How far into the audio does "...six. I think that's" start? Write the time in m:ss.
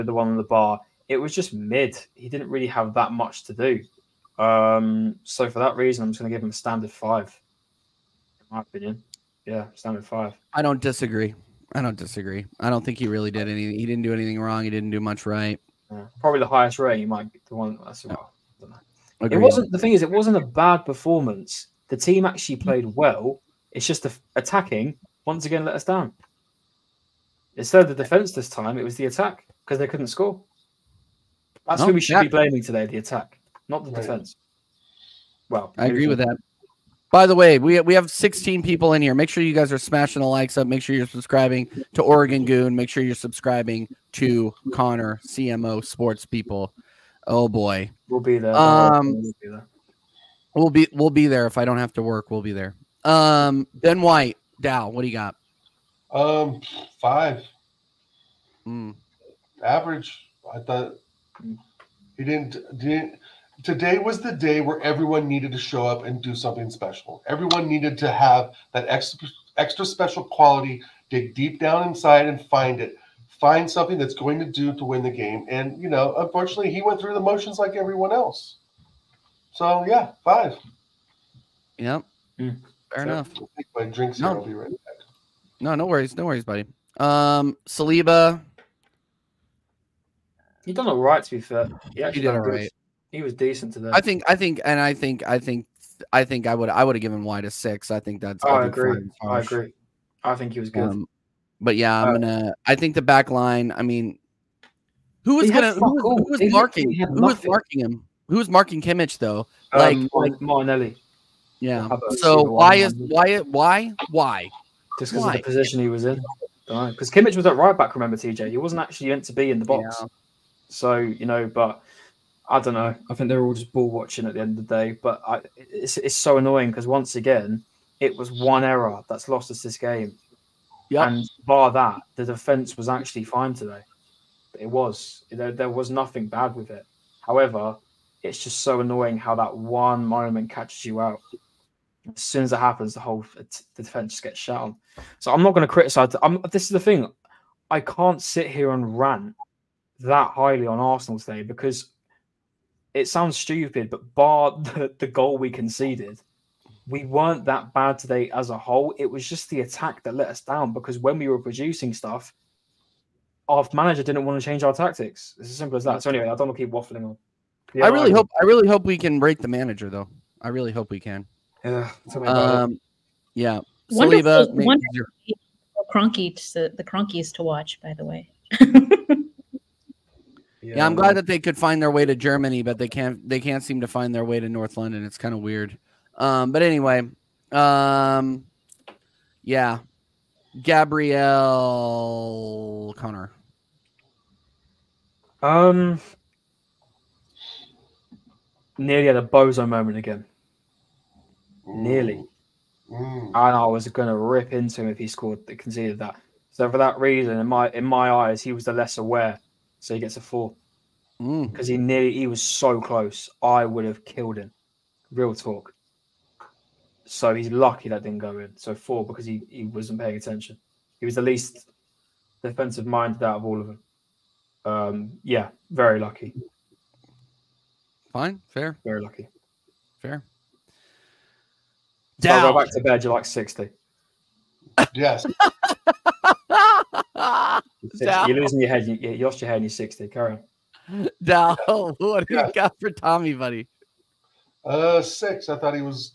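1:37.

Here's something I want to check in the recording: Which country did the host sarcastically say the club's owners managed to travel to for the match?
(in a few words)
Germany.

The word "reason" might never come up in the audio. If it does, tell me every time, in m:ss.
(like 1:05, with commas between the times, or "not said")
0:05, 3:26.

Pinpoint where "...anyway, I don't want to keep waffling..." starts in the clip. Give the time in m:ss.
2:46.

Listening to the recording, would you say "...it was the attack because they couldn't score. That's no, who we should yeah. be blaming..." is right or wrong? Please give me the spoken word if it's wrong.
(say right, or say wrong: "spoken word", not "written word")
right.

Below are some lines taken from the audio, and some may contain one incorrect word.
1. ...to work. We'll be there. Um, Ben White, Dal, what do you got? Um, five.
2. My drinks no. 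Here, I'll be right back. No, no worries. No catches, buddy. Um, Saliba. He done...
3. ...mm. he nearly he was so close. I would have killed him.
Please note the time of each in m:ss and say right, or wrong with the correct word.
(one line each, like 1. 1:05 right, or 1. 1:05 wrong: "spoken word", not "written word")
1. 0:51 right
2. 1:23 wrong: "worries", not "catches"
3. 3:31 right.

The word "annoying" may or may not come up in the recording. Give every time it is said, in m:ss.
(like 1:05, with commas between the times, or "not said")
2:06, 2:18.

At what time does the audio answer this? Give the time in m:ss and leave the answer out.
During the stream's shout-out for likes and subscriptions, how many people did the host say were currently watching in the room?
0:38.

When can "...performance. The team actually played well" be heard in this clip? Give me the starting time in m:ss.
0:20.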